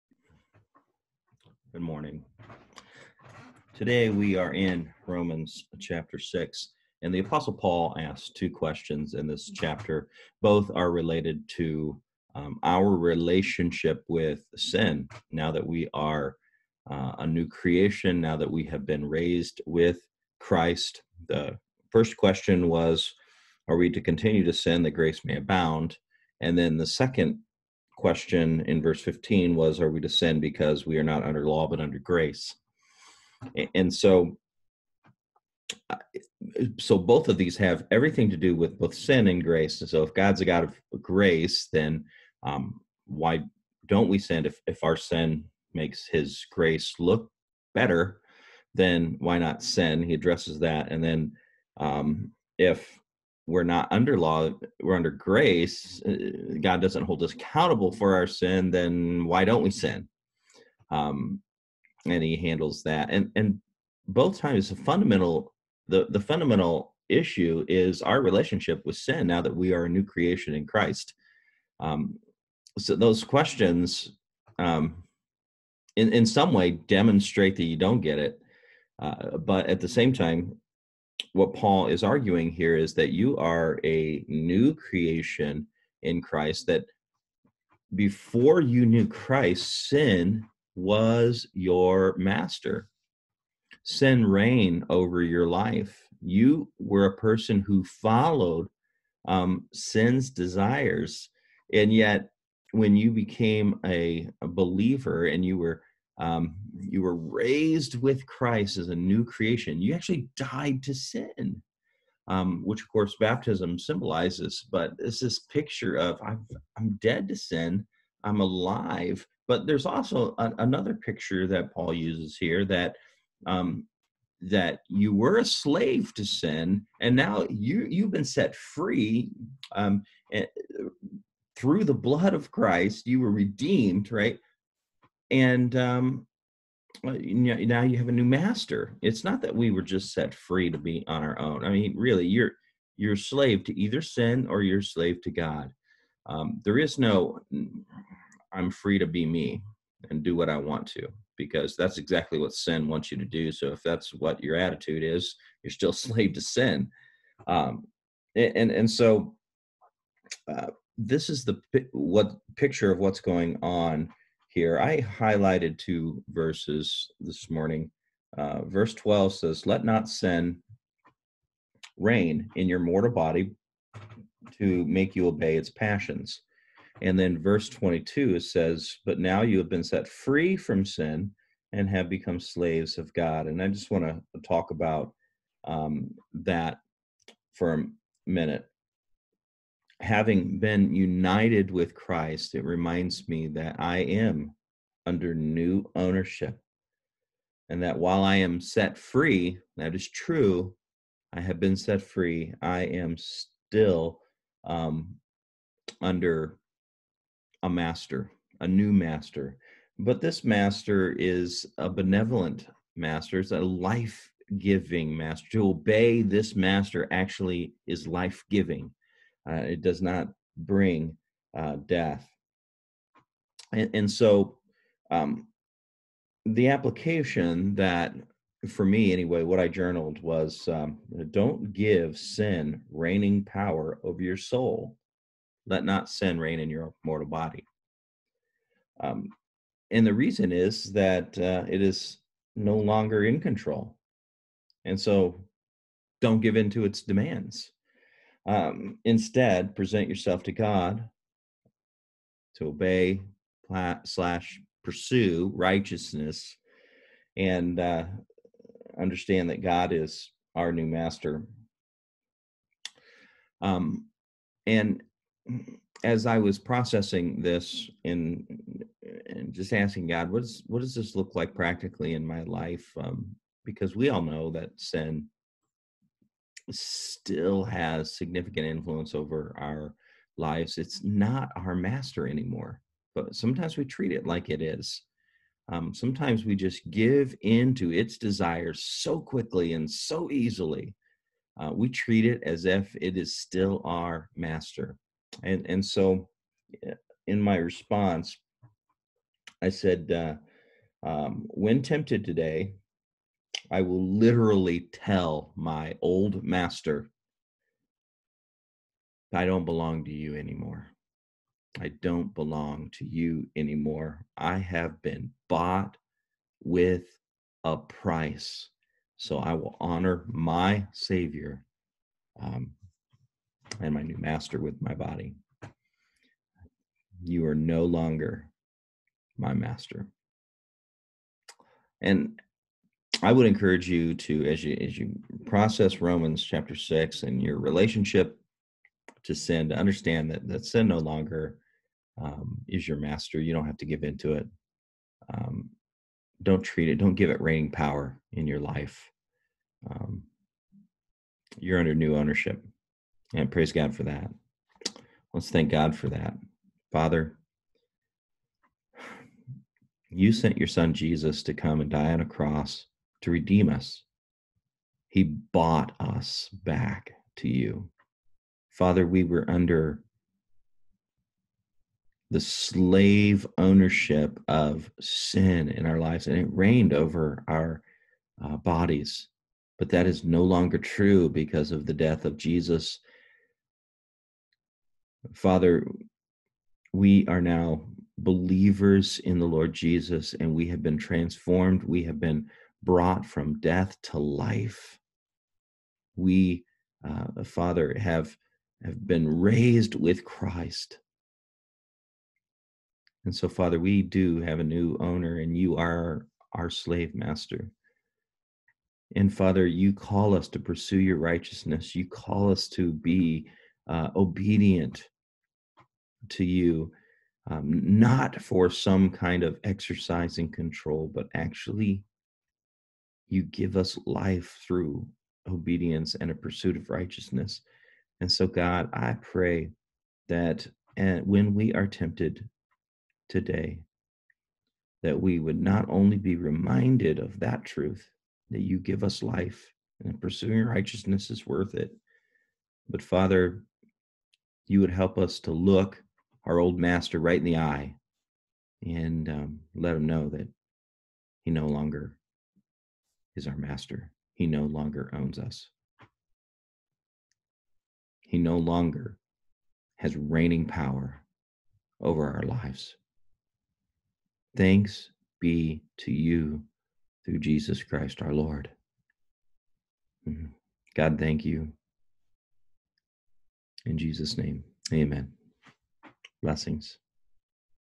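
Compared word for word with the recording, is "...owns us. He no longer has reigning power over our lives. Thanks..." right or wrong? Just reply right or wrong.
right.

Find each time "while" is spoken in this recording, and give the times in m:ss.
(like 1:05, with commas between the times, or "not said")
3:17.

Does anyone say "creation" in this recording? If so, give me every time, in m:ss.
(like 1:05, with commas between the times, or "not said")
0:17, 1:10, 1:24, 1:49.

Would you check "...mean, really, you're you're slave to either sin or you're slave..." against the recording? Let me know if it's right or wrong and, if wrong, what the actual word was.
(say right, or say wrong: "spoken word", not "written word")
right.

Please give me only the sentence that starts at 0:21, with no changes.
The first question was Are we to continue to sin that grace may abound?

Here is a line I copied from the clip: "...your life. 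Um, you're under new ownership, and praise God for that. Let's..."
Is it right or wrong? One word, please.
right.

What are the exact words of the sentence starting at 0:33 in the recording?
And so, so both of these have everything to do with both sin and grace.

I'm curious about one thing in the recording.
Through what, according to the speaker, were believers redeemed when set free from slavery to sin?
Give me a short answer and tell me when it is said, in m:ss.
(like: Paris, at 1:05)
The blood of Christ, at 2:11.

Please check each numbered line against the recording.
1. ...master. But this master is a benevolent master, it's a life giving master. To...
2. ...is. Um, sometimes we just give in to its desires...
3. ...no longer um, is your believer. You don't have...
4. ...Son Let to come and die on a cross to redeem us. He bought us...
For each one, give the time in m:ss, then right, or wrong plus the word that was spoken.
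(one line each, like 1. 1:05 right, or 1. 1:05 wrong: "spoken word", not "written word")
1. 3:28 right
2. 4:44 right
3. 5:40 wrong: "master", not "believer"
4. 6:00 wrong: "Jesus", not "Let".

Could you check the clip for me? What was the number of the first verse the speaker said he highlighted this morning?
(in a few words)
12.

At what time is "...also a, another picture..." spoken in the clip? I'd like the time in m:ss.
1:59.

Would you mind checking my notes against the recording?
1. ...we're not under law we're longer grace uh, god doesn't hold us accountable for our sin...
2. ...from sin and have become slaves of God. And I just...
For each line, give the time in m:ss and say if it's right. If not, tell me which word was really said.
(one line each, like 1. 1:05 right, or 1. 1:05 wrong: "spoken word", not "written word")
1. 0:53 wrong: "under", not "longer"
2. 3:00 right.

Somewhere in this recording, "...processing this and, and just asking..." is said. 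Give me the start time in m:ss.
4:26.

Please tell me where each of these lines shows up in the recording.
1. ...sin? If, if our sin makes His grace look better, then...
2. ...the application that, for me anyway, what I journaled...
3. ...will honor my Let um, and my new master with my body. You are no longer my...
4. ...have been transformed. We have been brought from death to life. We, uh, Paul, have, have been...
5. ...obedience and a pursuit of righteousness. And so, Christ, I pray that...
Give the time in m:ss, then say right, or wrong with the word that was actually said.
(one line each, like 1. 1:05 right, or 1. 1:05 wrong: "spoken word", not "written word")
1. 0:44 right
2. 3:46 right
3. 5:19 wrong: "Savior", not "Let"
4. 6:30 wrong: "Father", not "Paul"
5. 7:05 wrong: "God", not "Christ".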